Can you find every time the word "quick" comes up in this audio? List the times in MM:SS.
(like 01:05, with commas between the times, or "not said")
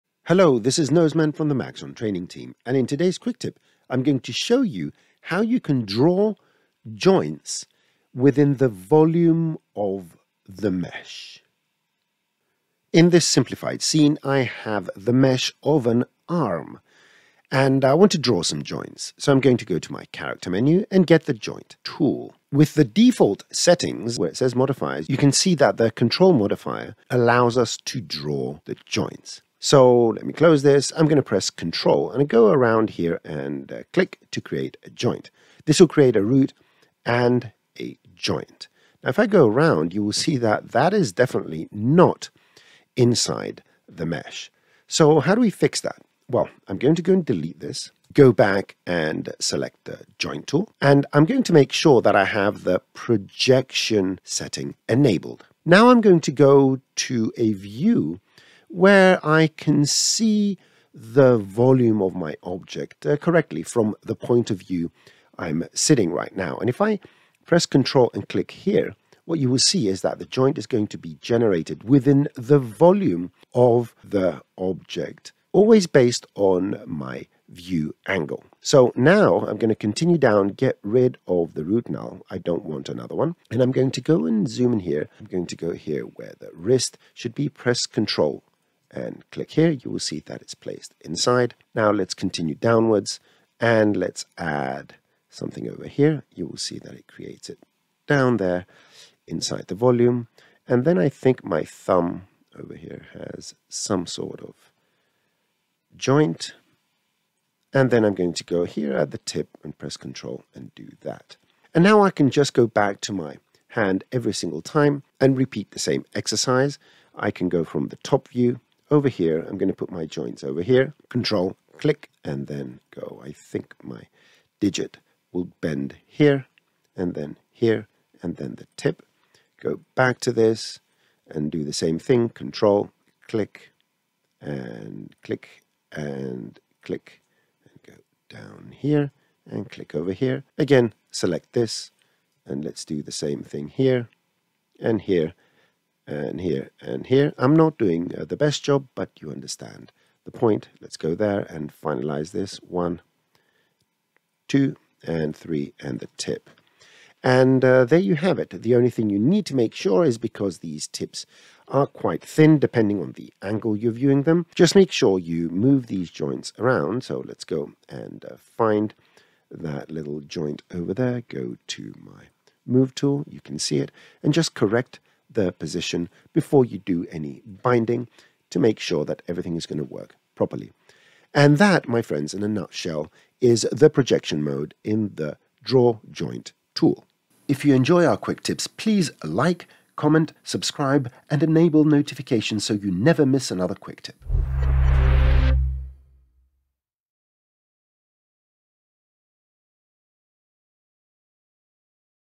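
00:03, 03:08, 03:13.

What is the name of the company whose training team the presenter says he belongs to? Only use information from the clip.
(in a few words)
Maxon.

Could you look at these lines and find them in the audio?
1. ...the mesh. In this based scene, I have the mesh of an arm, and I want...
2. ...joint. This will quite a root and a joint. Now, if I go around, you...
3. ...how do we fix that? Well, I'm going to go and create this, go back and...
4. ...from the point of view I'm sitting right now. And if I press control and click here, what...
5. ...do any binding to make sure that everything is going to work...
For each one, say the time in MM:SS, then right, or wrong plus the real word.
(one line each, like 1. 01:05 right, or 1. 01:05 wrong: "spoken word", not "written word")
1. 00:10 wrong: "simplified", not "based"
2. 00:34 wrong: "create", not "quite"
3. 00:45 wrong: "delete", not "create"
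4. 01:03 right
5. 02:56 right.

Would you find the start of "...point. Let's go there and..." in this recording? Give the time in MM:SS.
02:30.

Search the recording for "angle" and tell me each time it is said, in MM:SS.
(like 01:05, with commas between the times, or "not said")
01:18, 02:43.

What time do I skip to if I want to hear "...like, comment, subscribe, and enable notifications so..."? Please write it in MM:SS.
03:09.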